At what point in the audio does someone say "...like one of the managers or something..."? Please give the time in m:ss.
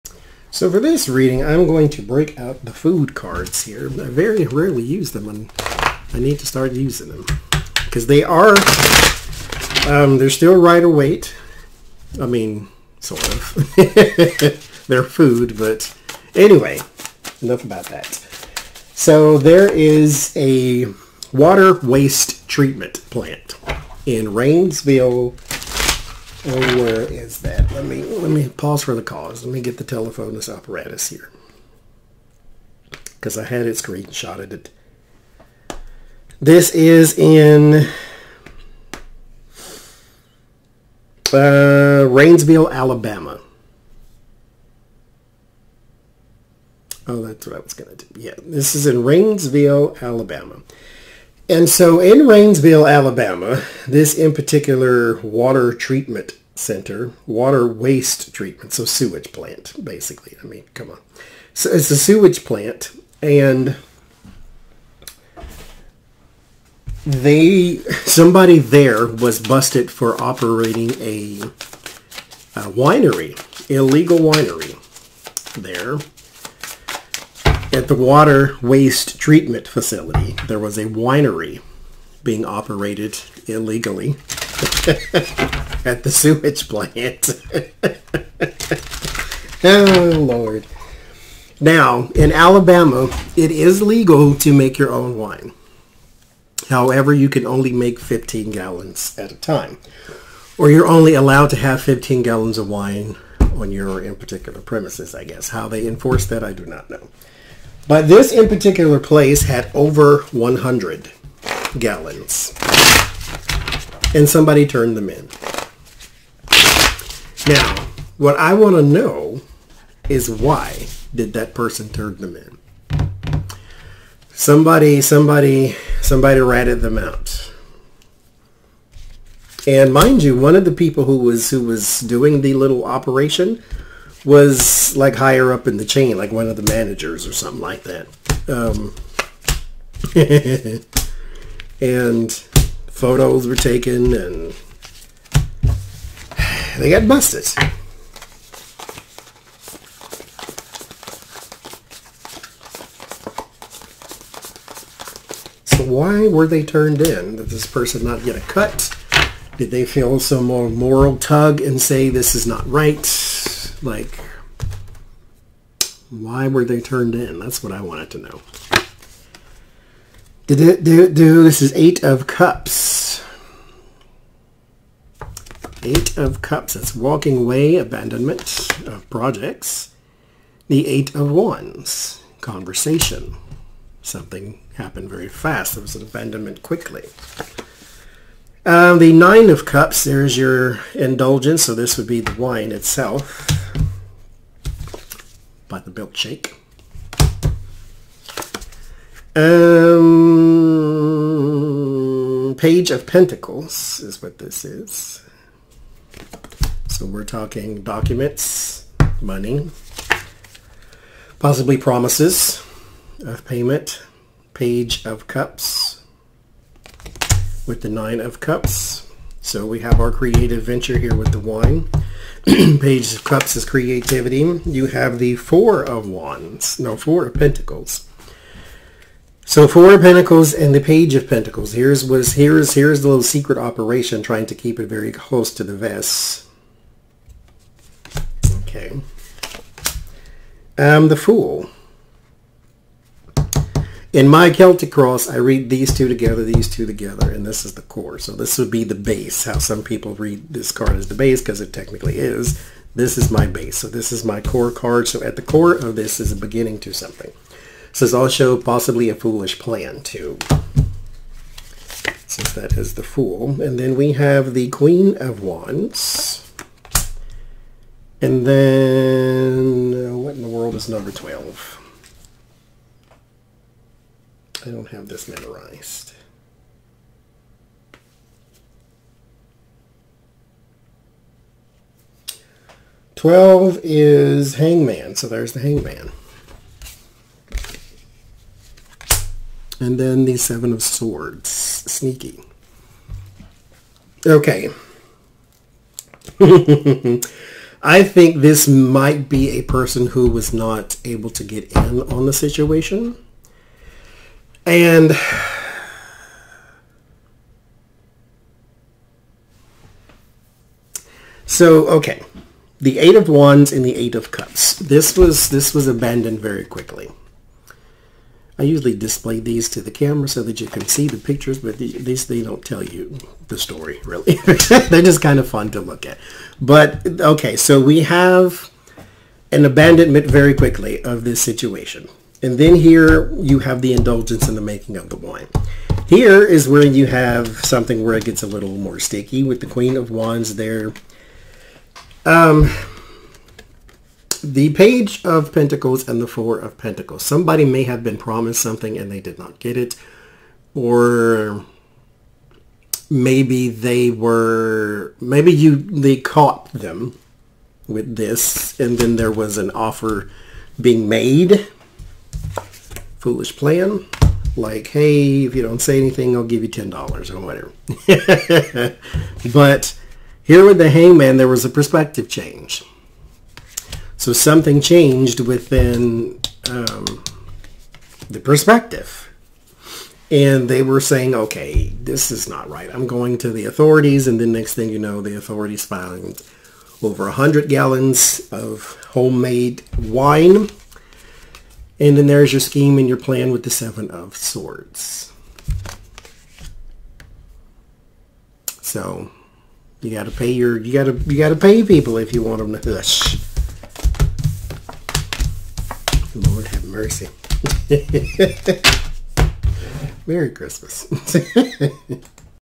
2:16.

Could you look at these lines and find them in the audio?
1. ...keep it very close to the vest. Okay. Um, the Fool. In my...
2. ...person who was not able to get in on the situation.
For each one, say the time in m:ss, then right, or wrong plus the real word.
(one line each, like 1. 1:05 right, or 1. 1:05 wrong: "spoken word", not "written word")
1. 3:54 right
2. 4:59 right.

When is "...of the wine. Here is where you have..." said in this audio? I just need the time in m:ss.
5:34.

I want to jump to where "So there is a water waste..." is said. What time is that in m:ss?
0:18.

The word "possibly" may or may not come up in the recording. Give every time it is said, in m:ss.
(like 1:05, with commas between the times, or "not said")
3:31, 4:18.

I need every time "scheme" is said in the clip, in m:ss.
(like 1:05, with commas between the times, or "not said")
6:32.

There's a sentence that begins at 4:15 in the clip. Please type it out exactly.
So at the core of this is a beginning to something.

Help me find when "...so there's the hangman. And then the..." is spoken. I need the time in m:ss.
4:45.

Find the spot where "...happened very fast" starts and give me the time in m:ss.
3:04.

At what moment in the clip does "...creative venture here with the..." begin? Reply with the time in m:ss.
3:40.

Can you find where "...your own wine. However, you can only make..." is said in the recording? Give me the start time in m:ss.
1:34.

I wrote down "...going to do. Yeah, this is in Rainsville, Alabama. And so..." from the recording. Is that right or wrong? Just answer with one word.
right.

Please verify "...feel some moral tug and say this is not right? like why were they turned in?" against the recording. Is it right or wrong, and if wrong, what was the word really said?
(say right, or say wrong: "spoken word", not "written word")
right.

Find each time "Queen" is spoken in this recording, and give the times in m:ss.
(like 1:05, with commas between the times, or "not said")
4:24, 5:39.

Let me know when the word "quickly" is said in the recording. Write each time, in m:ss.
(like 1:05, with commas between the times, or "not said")
3:06, 5:16, 5:30.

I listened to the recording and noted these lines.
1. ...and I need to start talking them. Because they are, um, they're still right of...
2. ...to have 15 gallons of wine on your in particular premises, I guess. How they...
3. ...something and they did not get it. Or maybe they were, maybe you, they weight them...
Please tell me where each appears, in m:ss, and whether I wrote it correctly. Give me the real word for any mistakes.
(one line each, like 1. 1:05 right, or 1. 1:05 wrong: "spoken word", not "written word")
1. 0:05 wrong: "using", not "talking"
2. 1:41 right
3. 5:48 wrong: "caught", not "weight".